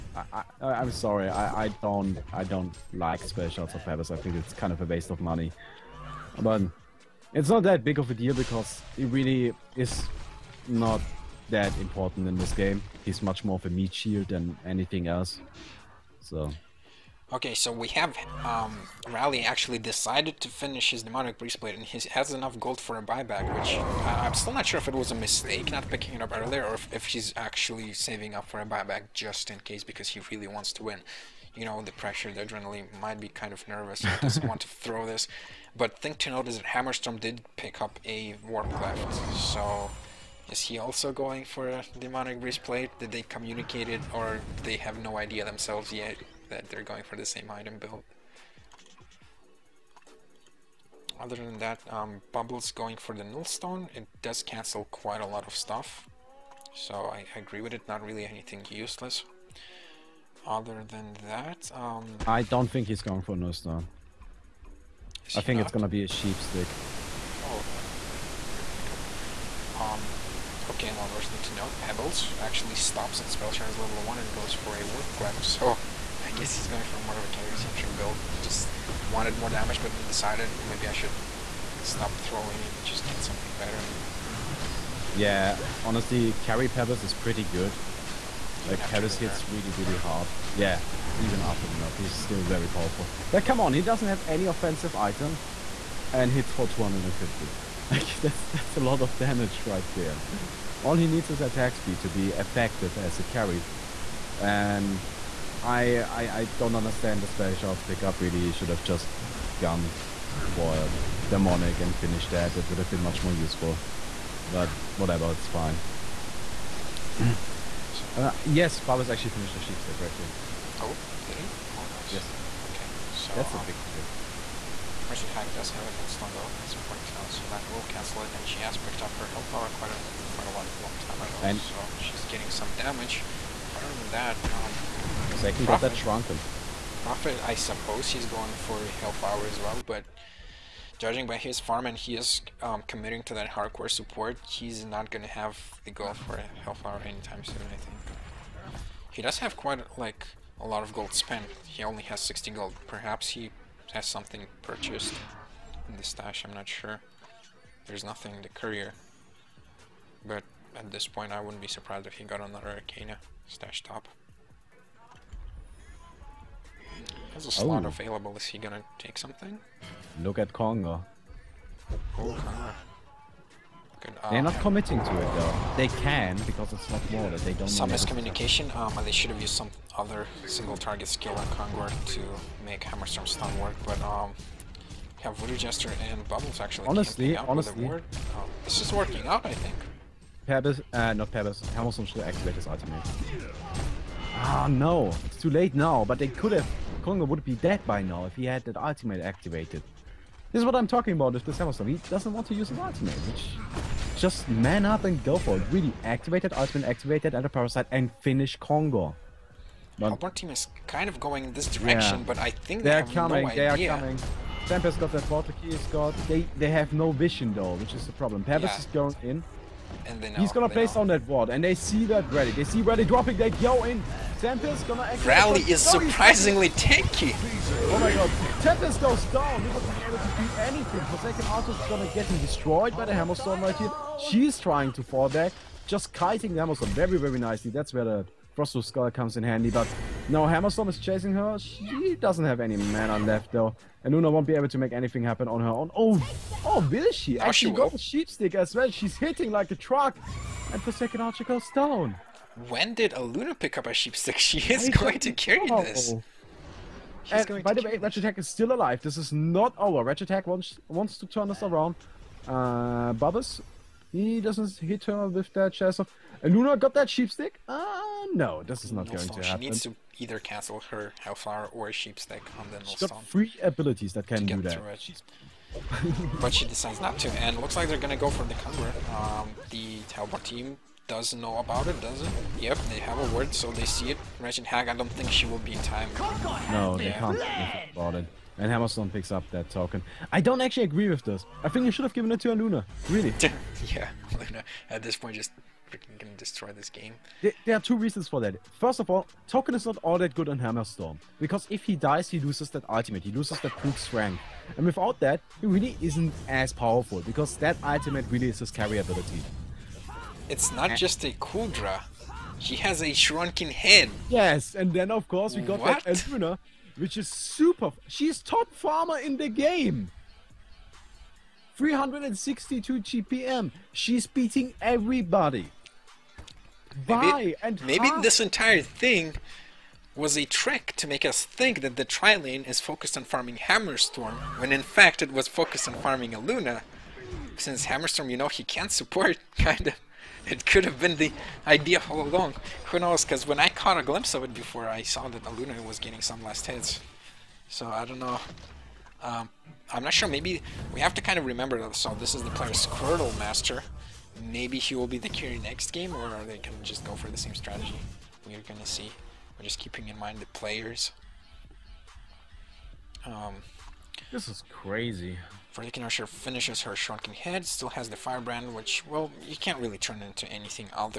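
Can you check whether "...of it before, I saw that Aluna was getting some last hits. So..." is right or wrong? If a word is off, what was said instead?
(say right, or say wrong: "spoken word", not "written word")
right.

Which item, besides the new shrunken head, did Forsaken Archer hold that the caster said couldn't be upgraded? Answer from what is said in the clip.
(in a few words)
Firebrand.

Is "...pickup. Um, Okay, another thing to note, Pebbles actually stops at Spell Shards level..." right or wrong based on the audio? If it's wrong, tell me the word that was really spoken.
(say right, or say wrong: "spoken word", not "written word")
right.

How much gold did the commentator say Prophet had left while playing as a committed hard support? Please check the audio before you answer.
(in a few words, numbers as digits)
60.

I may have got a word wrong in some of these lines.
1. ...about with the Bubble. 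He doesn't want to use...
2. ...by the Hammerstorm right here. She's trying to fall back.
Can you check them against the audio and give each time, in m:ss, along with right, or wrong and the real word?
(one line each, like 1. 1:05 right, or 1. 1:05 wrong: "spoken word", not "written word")
1. 3:21 wrong: "Hammerstorm", not "Bubble"
2. 3:52 right.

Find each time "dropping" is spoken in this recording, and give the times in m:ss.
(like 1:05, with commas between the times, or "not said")
3:43.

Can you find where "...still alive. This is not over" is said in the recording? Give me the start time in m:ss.
4:18.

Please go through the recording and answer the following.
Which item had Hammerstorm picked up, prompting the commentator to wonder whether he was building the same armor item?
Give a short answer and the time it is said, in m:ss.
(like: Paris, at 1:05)
Warpcleft, at 0:38.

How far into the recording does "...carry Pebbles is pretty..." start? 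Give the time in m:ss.
1:26.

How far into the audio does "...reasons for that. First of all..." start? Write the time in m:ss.
4:57.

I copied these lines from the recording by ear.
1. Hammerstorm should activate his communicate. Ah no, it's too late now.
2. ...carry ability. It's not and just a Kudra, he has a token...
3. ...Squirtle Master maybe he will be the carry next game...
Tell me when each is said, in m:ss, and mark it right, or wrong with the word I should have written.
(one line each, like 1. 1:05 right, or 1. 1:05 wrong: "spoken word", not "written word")
1. 3:11 wrong: "ultimate", not "communicate"
2. 5:08 wrong: "shrunken", not "token"
3. 5:52 right.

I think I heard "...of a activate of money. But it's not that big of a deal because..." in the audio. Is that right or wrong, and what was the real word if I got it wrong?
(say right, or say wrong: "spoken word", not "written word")
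wrong: "waste", not "activate".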